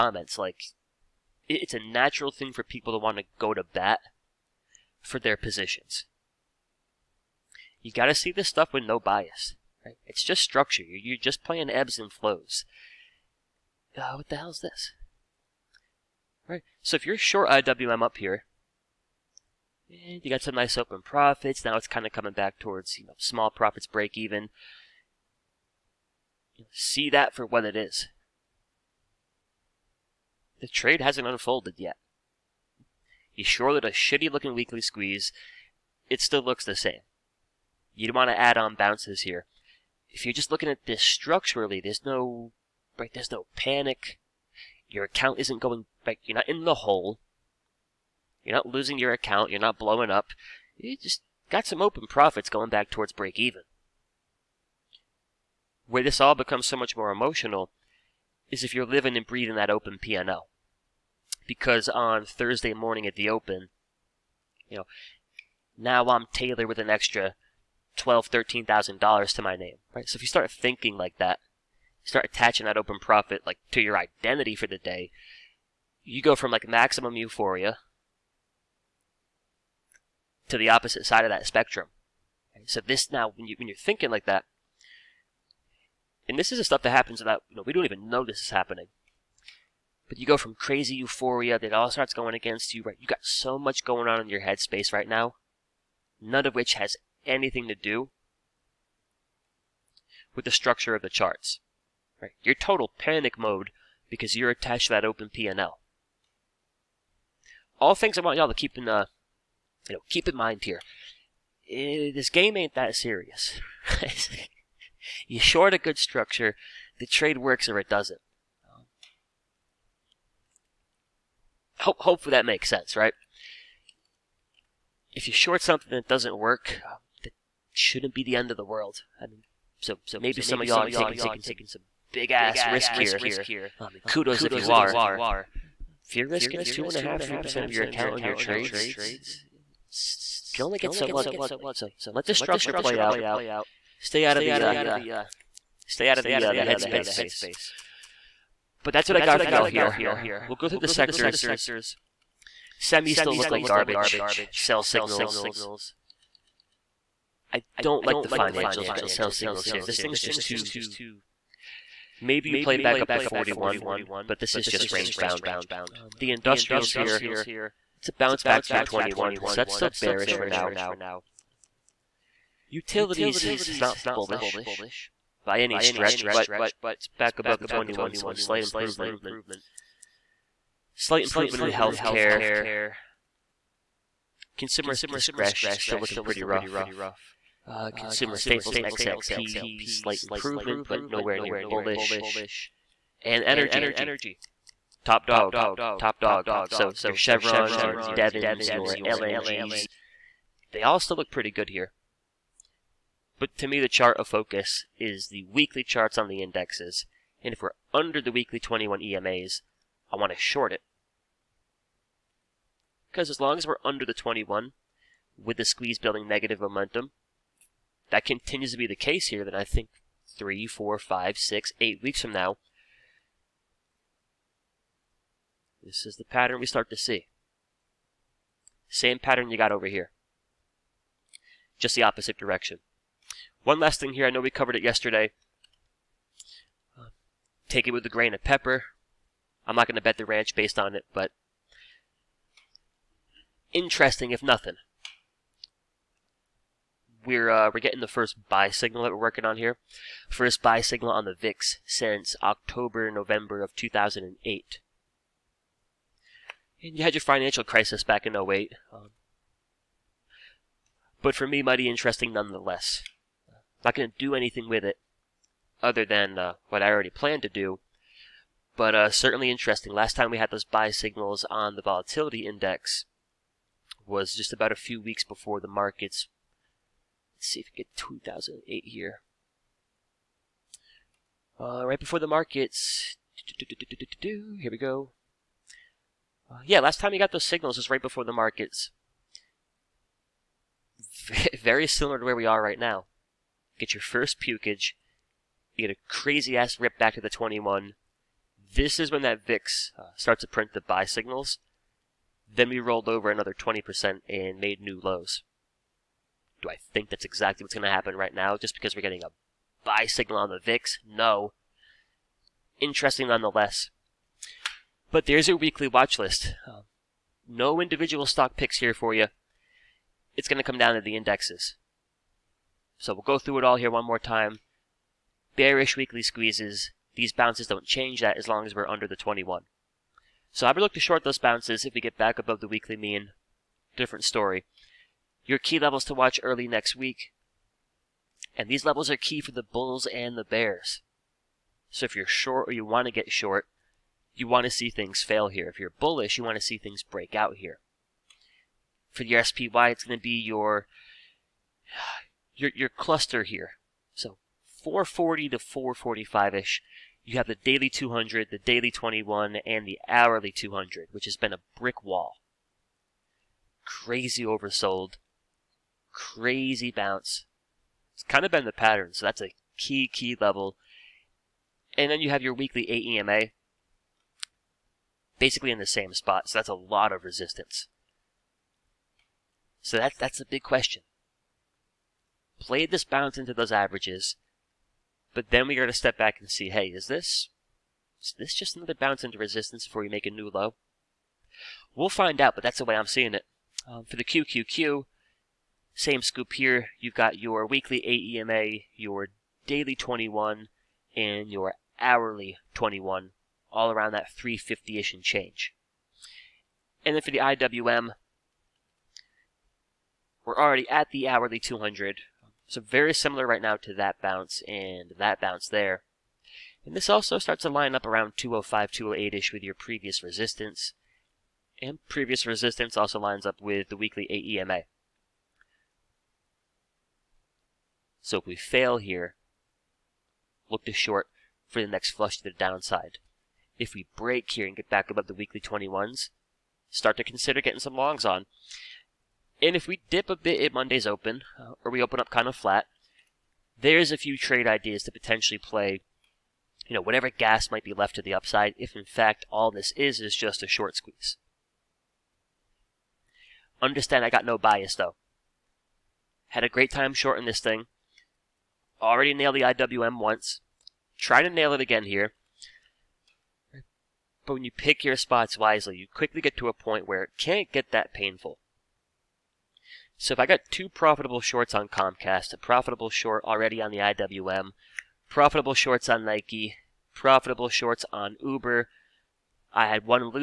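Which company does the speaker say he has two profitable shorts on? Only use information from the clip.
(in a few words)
Comcast.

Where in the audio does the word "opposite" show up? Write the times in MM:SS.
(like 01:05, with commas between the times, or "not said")
01:20, 03:52.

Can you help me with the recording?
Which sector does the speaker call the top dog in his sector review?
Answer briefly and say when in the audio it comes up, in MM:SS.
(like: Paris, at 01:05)
Energy, at 03:13.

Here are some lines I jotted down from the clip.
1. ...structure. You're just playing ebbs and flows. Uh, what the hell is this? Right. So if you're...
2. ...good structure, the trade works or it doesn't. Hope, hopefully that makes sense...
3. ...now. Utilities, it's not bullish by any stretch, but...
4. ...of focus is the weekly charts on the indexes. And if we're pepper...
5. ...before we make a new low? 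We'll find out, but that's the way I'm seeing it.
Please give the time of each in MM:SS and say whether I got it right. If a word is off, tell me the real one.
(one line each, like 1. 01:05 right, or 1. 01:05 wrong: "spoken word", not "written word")
1. 00:10 right
2. 01:55 right
3. 02:50 right
4. 03:24 wrong: "under", not "pepper"
5. 06:29 right.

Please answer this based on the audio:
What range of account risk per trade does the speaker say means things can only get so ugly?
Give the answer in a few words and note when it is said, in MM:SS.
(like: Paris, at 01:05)
2.5 to 3 percent, at 02:16.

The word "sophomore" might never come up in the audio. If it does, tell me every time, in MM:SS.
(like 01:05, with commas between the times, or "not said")
not said.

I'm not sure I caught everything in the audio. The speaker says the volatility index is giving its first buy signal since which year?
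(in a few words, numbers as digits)
2008.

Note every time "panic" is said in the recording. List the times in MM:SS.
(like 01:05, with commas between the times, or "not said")
00:43, 01:42.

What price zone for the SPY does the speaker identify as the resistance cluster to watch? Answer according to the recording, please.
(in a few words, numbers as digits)
440 to 445.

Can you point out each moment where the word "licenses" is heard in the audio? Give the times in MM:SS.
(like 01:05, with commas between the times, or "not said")
not said.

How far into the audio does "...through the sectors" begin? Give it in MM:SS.
02:30.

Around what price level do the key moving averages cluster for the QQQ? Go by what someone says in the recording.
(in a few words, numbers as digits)
350.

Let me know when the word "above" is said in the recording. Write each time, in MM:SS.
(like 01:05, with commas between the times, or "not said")
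02:57, 05:32, 07:15.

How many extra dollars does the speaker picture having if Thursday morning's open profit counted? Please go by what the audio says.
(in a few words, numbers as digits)
12,000 to 13,000 dollars.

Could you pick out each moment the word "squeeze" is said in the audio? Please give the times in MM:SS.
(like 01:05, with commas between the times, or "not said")
00:34, 03:35, 05:26, 07:30.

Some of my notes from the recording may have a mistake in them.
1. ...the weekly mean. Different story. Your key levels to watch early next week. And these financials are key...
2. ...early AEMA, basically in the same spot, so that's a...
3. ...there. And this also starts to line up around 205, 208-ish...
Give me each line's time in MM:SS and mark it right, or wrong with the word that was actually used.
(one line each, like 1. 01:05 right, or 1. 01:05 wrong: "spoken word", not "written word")
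1. 05:32 wrong: "levels", not "financials"
2. 06:12 wrong: "weekly", not "early"
3. 06:55 right.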